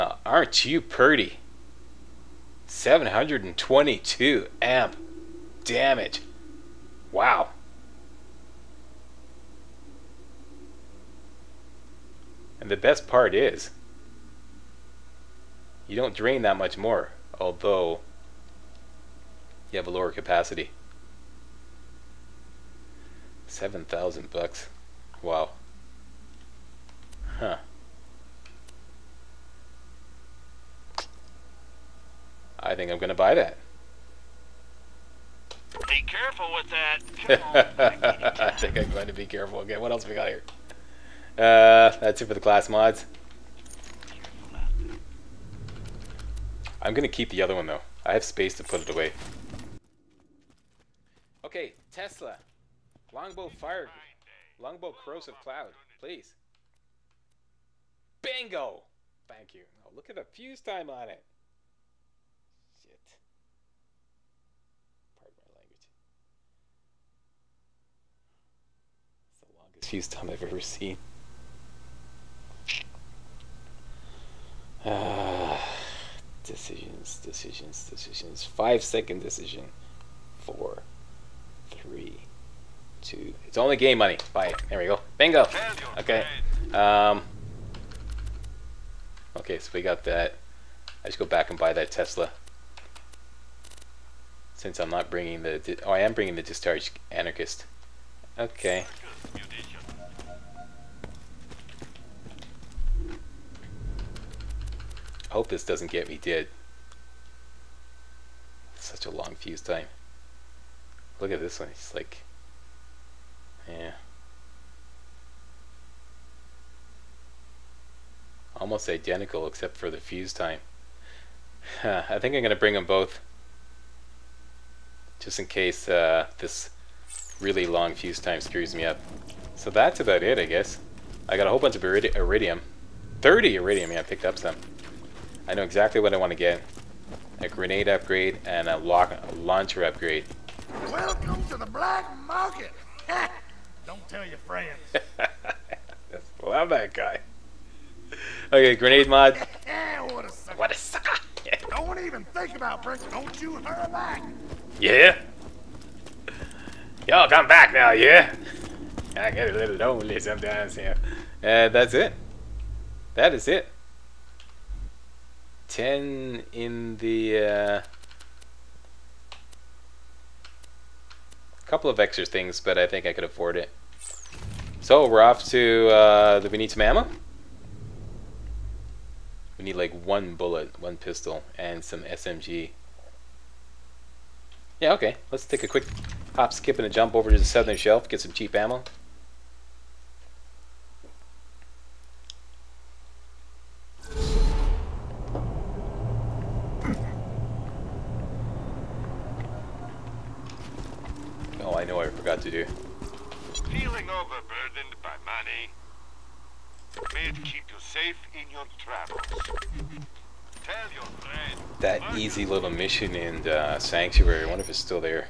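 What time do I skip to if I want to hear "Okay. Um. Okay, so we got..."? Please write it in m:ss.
1:25.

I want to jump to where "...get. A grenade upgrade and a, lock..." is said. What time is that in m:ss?
2:16.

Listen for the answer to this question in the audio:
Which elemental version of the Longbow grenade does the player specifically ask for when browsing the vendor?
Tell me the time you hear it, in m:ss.
0:54.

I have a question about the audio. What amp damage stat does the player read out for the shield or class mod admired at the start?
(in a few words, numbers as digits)
722 amp damage.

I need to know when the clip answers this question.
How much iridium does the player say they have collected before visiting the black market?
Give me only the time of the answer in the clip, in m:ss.
2:13.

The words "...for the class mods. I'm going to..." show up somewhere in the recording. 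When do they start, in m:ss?
0:42.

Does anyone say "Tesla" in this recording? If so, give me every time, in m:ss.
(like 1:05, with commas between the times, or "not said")
0:51, 1:31.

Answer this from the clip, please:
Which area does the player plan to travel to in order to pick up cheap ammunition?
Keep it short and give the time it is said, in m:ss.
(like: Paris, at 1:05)
the southern shelf, at 3:07.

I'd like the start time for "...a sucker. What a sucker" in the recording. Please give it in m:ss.
2:30.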